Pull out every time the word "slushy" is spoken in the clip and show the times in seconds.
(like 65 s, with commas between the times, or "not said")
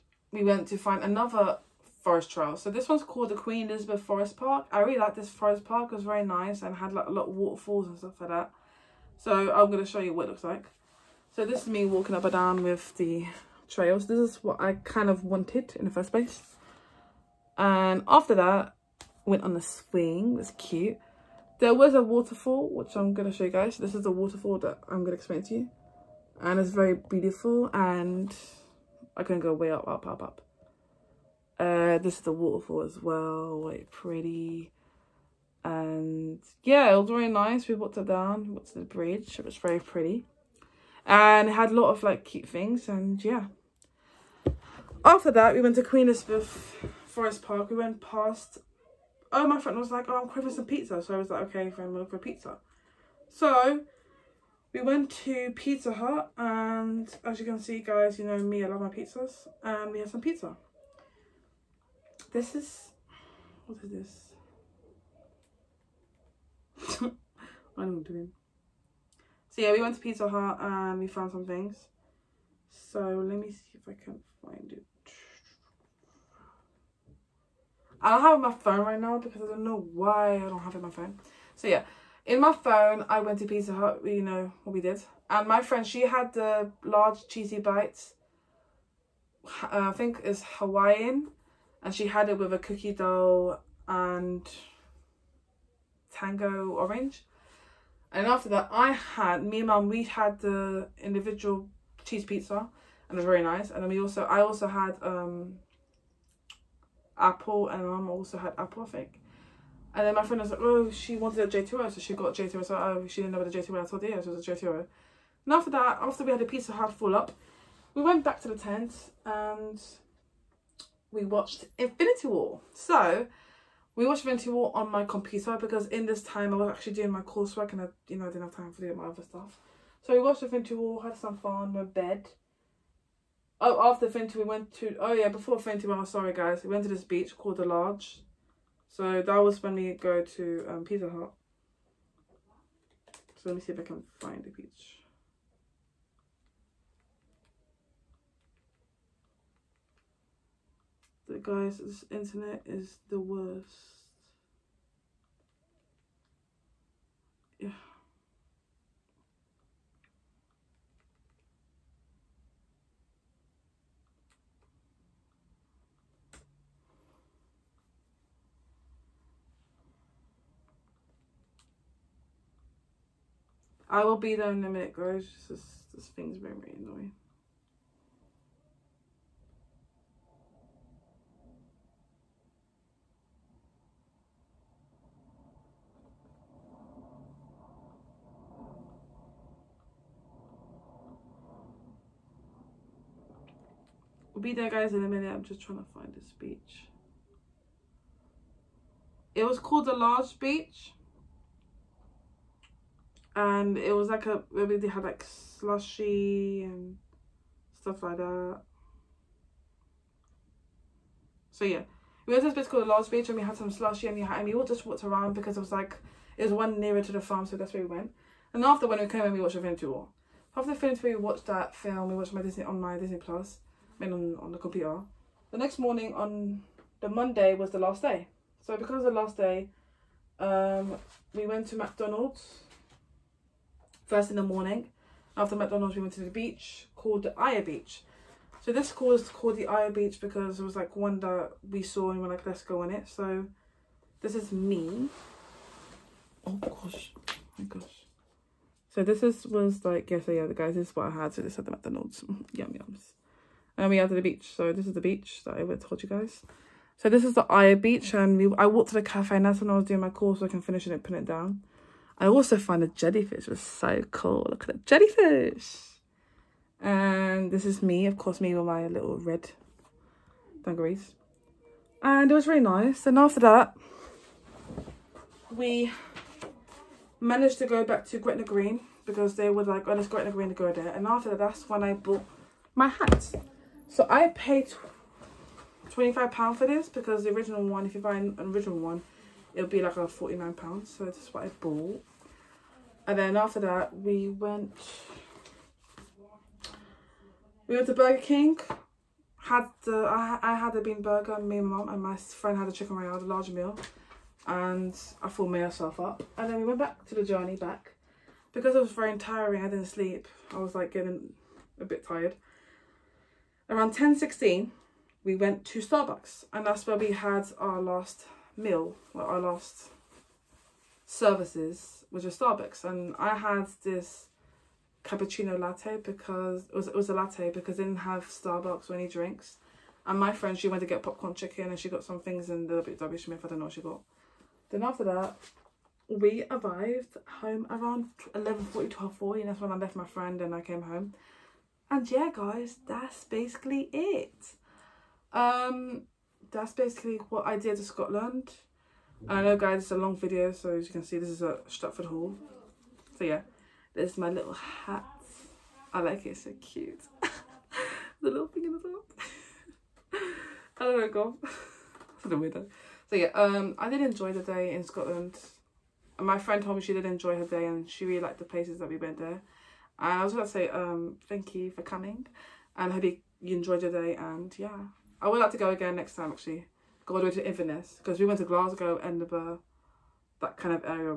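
205 s, 213 s.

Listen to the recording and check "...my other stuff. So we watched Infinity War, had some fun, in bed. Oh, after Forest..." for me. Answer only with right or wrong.
wrong.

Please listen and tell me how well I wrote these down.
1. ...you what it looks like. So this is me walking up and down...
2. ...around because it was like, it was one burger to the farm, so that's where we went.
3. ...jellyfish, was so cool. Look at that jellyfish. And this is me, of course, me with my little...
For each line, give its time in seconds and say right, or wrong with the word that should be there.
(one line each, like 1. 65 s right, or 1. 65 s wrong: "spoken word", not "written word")
1. 9 s right
2. 215 s wrong: "nearer", not "burger"
3. 262 s right.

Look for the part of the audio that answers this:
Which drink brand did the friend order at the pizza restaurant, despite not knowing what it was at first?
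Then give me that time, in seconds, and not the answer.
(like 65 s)
112 s.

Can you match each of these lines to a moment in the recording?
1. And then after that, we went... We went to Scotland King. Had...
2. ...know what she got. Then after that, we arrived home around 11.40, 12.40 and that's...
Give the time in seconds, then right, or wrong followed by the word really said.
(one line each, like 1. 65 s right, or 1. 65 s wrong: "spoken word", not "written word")
1. 293 s wrong: "Burger", not "Scotland"
2. 333 s right.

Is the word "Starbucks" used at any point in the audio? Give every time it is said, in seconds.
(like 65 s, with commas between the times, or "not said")
315 s, 322 s, 328 s.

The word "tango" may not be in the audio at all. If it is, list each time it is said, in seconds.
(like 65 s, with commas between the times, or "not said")
96 s.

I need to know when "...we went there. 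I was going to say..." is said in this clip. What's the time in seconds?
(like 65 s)
368 s.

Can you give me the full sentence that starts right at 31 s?
Uh, this is the waterfall as well, like pretty.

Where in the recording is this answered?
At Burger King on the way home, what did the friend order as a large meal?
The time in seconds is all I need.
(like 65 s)
302 s.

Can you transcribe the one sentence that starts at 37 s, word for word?
We walked up down, walked to the bridge.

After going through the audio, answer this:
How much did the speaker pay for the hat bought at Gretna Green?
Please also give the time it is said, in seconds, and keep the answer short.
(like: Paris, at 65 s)
£25, at 285 s.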